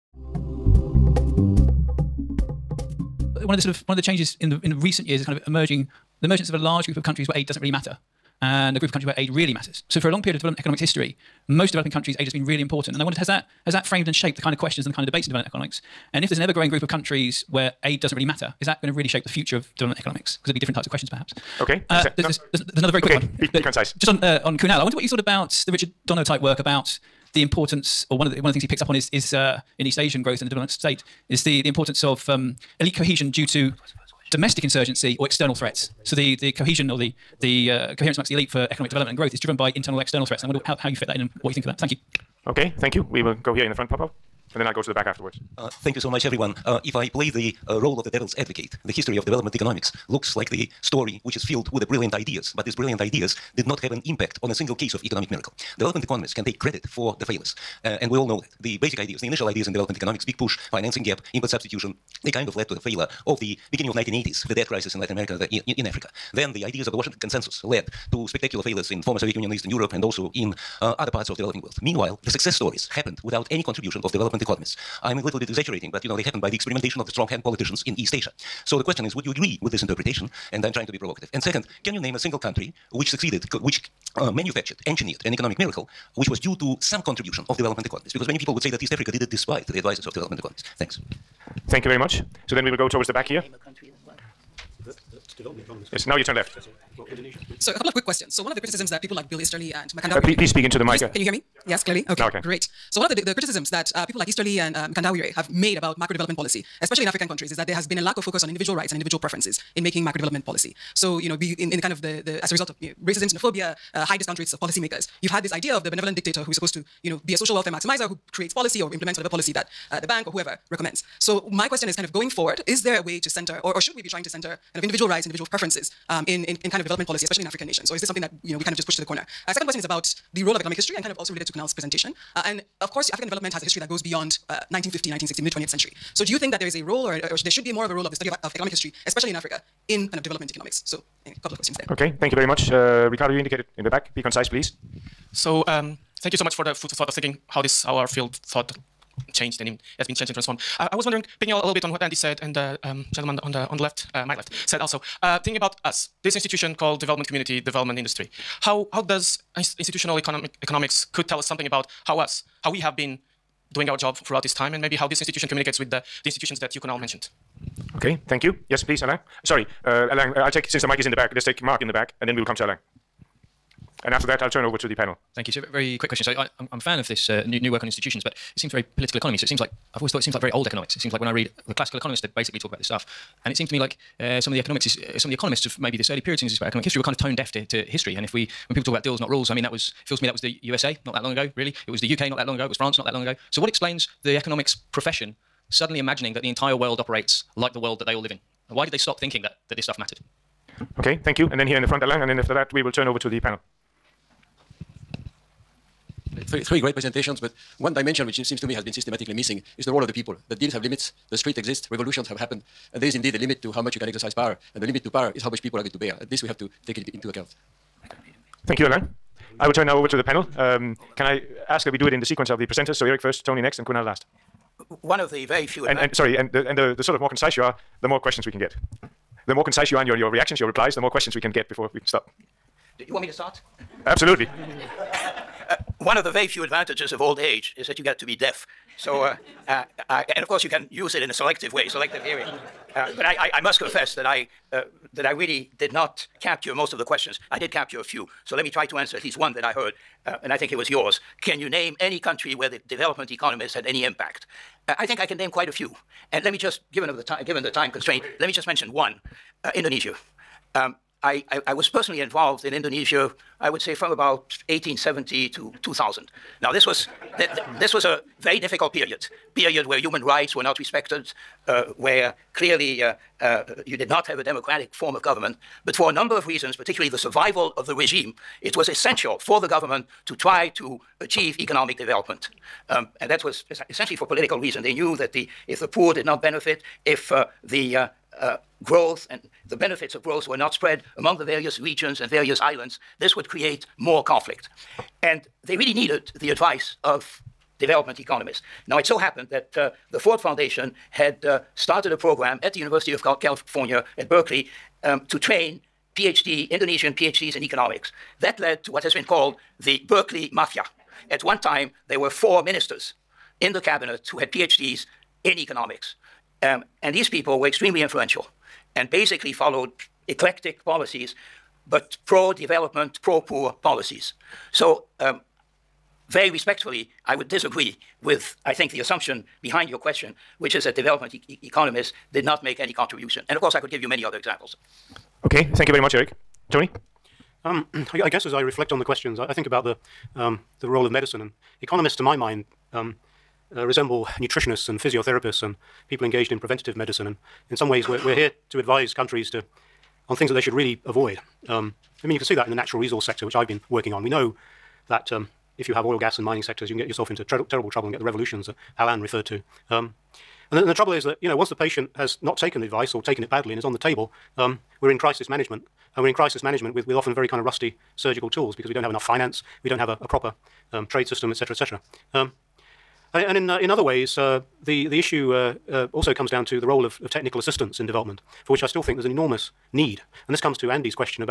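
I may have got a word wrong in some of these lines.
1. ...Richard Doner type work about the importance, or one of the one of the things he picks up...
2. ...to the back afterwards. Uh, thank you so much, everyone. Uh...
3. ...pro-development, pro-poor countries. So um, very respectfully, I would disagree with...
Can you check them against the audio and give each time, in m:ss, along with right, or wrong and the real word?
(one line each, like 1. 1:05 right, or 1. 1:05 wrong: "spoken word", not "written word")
1. 0:25 right
2. 0:44 right
3. 5:22 wrong: "policies", not "countries".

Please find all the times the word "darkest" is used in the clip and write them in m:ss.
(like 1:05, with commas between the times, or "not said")
not said.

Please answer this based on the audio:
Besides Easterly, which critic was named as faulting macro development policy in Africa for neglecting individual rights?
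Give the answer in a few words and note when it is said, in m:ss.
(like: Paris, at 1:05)
Mkandawire, at 1:44.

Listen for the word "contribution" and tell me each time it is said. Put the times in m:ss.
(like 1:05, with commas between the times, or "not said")
1:13, 1:27, 5:32.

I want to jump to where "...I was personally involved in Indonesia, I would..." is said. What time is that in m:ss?
4:21.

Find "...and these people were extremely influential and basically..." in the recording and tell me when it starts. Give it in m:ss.
5:17.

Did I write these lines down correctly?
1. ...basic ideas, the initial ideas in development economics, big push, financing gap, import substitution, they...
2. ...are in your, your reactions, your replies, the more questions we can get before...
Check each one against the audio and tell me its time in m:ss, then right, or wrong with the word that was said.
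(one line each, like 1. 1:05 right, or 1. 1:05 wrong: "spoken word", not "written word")
1. 0:58 right
2. 3:49 right.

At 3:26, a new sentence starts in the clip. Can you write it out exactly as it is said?
Three, three great presentations, but one dimension which seems to me has been systematically missing is the role of the people.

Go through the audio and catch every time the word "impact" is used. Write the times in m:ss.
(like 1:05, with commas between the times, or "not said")
0:54, 4:14.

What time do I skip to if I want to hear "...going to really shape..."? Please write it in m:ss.
0:18.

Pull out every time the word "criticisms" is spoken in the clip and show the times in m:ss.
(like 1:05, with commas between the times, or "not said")
1:38, 1:43.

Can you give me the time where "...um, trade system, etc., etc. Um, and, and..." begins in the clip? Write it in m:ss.
6:10.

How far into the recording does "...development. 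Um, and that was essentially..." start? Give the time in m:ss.
4:41.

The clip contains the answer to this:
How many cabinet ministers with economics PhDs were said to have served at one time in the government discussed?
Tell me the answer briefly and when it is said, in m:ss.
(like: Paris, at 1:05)
4, at 5:12.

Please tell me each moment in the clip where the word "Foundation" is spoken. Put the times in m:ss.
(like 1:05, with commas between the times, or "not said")
5:00.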